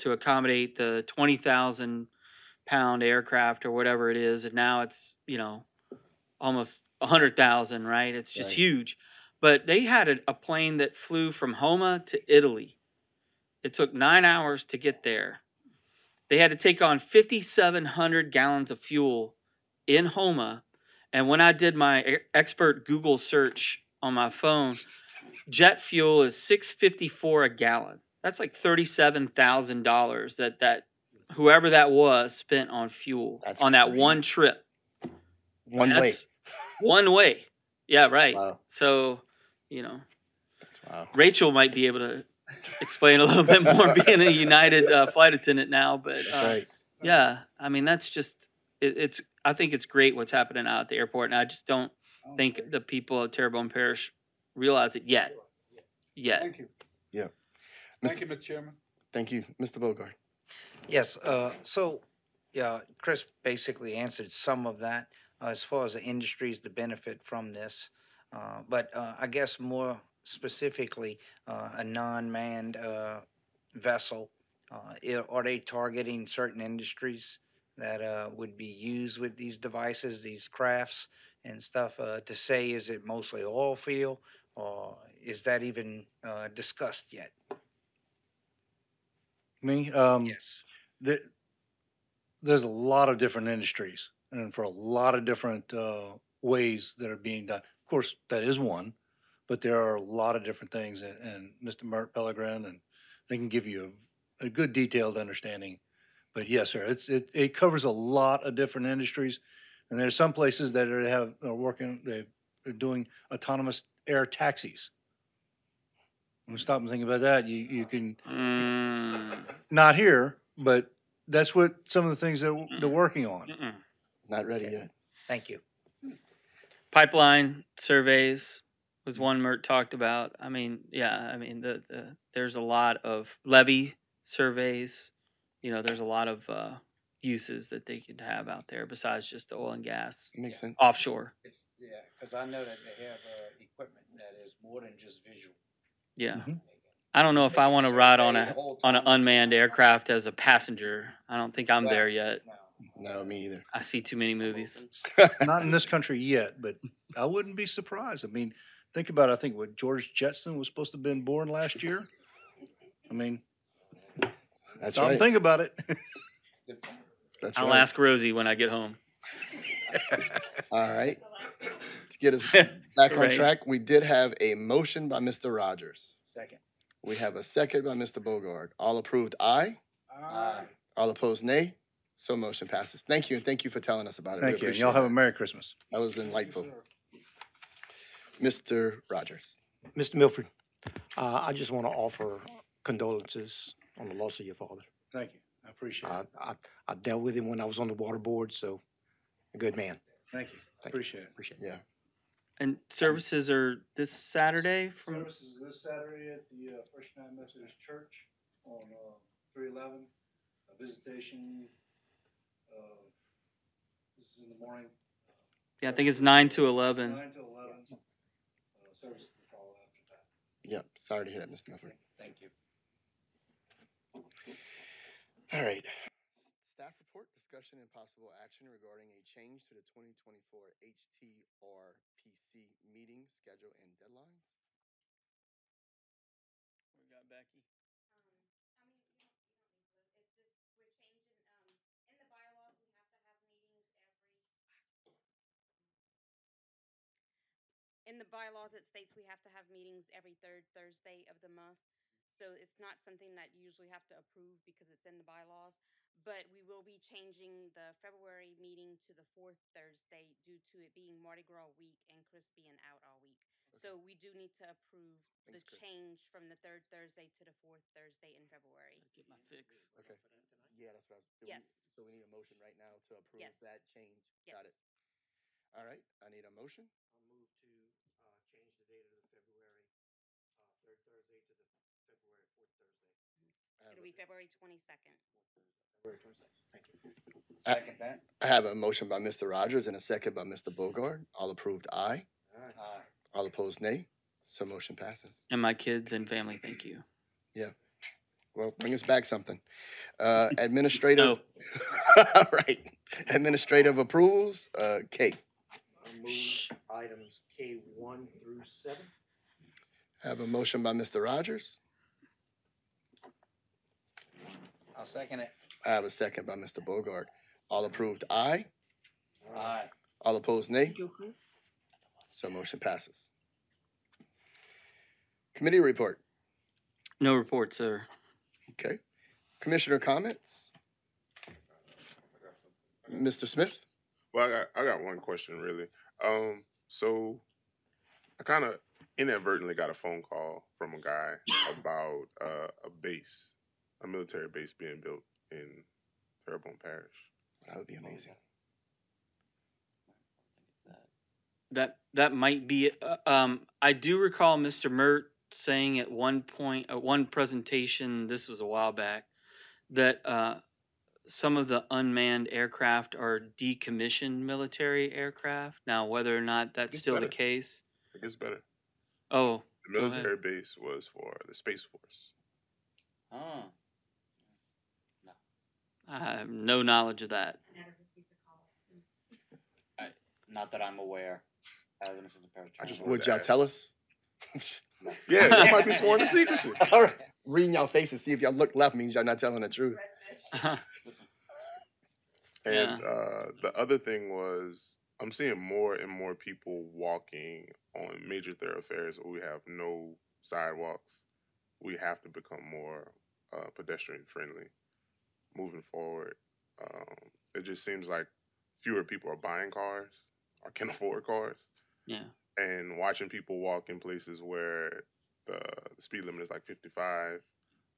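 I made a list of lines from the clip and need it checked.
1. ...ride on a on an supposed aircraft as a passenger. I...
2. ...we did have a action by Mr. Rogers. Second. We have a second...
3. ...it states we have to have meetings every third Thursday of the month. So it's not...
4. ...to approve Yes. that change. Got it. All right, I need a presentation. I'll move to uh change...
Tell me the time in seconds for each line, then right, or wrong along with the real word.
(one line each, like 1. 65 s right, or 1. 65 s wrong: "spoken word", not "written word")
1. 147 s wrong: "unmanned", not "supposed"
2. 173 s wrong: "motion", not "action"
3. 248 s right
4. 272 s wrong: "motion", not "presentation".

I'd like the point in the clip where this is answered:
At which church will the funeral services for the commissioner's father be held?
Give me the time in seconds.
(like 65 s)
206 s.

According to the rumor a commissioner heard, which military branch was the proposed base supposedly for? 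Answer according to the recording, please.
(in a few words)
Space Force.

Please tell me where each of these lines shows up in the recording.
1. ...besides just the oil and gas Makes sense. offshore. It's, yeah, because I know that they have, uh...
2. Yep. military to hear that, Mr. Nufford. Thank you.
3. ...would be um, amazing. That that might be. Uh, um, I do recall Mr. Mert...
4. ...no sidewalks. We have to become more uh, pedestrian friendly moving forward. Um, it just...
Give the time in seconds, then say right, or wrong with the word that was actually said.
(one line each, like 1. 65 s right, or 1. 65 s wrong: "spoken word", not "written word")
1. 138 s right
2. 220 s wrong: "sorry", not "military"
3. 347 s right
4. 399 s right.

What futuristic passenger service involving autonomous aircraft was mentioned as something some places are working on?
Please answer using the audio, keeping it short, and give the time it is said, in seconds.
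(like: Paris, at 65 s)
autonomous air taxis, at 113 s.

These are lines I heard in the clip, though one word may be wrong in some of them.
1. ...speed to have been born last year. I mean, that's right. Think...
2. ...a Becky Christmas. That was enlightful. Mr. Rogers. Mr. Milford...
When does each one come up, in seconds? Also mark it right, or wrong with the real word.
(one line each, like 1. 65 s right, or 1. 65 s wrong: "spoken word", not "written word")
1. 160 s wrong: "supposed", not "speed"
2. 185 s wrong: "Merry", not "Becky".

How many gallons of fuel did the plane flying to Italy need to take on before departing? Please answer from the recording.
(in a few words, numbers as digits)
5,700.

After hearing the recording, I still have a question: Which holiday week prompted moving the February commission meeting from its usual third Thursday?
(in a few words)
Mardi Gras.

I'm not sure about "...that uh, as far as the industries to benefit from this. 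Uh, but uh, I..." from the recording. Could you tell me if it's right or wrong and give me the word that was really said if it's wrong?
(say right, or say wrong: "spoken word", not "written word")
right.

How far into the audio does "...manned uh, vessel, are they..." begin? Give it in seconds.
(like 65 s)
72 s.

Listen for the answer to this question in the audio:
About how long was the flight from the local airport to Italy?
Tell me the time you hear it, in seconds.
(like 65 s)
13 s.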